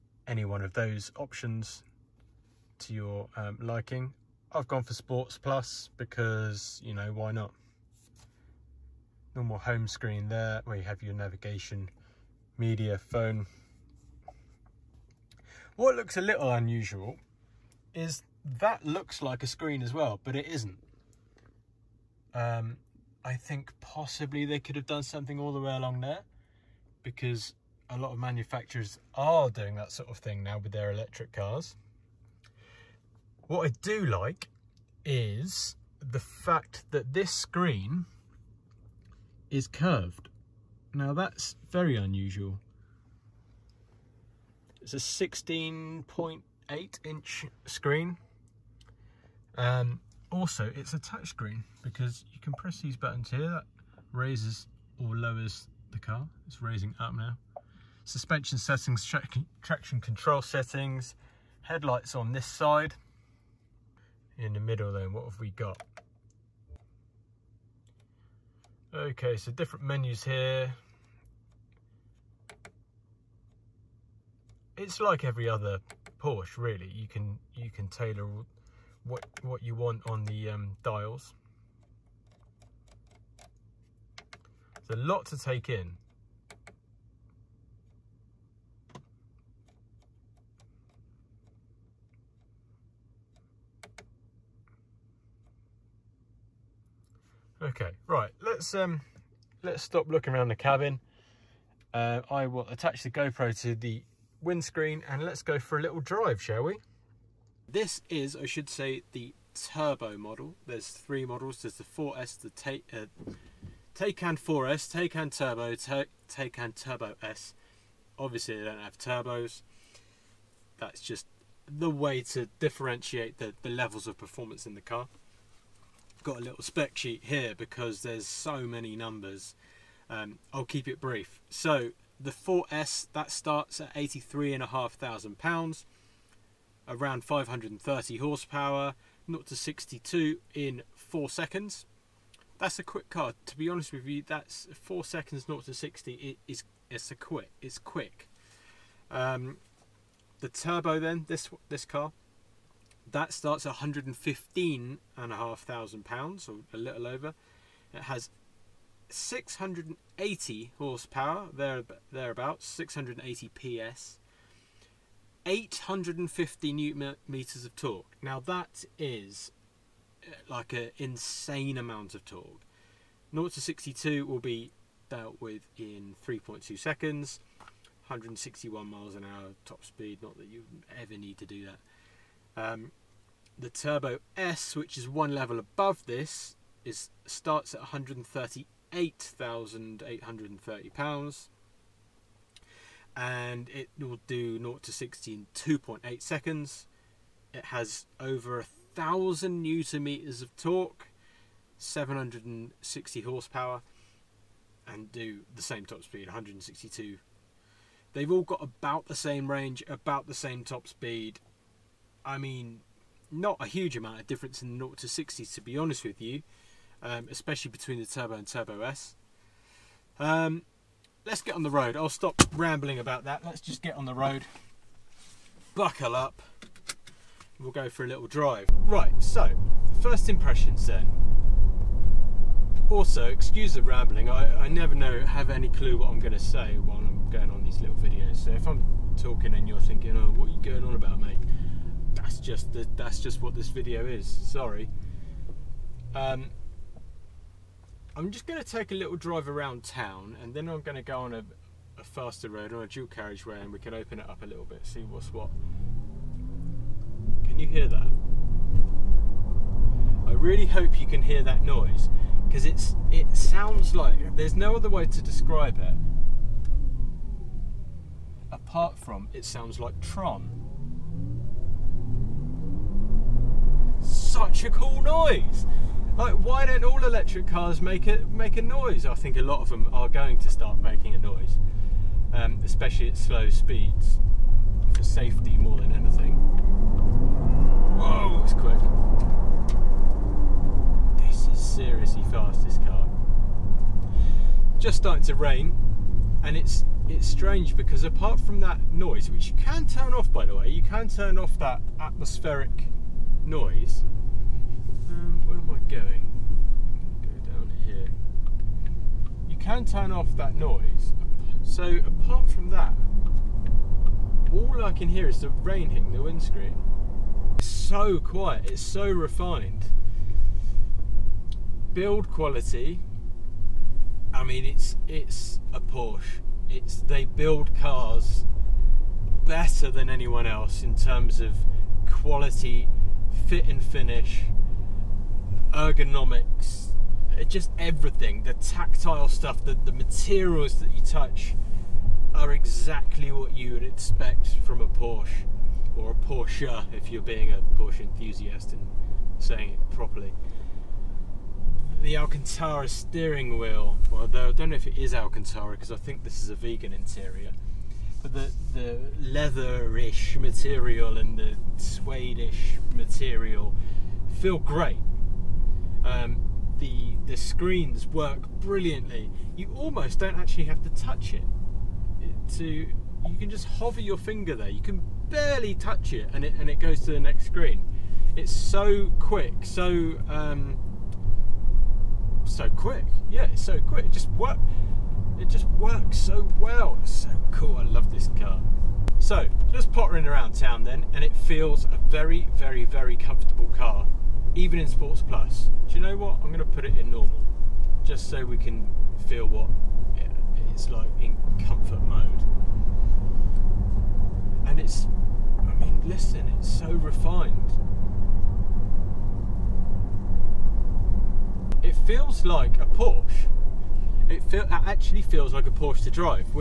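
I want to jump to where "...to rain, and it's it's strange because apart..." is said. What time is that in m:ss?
4:55.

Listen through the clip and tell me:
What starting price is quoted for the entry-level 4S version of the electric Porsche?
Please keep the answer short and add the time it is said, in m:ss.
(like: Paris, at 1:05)
£83,500, at 2:13.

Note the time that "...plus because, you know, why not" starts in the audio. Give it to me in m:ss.
0:05.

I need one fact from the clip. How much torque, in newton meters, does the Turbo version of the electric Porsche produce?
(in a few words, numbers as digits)
850 newton meters.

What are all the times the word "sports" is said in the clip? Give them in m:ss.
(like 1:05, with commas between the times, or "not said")
0:04, 6:34.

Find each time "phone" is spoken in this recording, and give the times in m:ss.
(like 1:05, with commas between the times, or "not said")
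0:12.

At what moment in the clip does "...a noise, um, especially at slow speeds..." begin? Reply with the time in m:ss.
4:41.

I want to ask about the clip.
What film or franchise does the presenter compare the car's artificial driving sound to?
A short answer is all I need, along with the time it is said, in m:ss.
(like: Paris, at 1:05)
Tron, at 4:30.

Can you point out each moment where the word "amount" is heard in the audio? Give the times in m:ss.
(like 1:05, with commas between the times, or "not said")
2:51, 3:33.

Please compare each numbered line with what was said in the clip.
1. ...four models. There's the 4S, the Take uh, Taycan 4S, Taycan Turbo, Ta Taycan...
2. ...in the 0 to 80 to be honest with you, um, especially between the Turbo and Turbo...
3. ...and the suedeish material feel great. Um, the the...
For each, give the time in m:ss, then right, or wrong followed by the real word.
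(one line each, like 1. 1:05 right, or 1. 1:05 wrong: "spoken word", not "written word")
1. 1:50 wrong: "three", not "four"
2. 3:34 wrong: "60", not "80"
3. 6:01 right.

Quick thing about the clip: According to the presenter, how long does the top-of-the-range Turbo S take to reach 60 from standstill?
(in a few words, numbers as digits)
2.8 seconds.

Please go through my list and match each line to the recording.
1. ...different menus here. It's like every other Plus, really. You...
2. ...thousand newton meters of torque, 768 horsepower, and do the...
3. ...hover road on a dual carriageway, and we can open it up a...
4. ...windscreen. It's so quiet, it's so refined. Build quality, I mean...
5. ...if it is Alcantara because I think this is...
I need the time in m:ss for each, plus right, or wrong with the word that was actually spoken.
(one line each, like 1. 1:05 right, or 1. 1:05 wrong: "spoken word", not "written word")
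1. 1:09 wrong: "Porsche", not "Plus"
2. 3:18 wrong: "760", not "768"
3. 4:12 wrong: "faster", not "hover"
4. 5:16 right
5. 5:54 right.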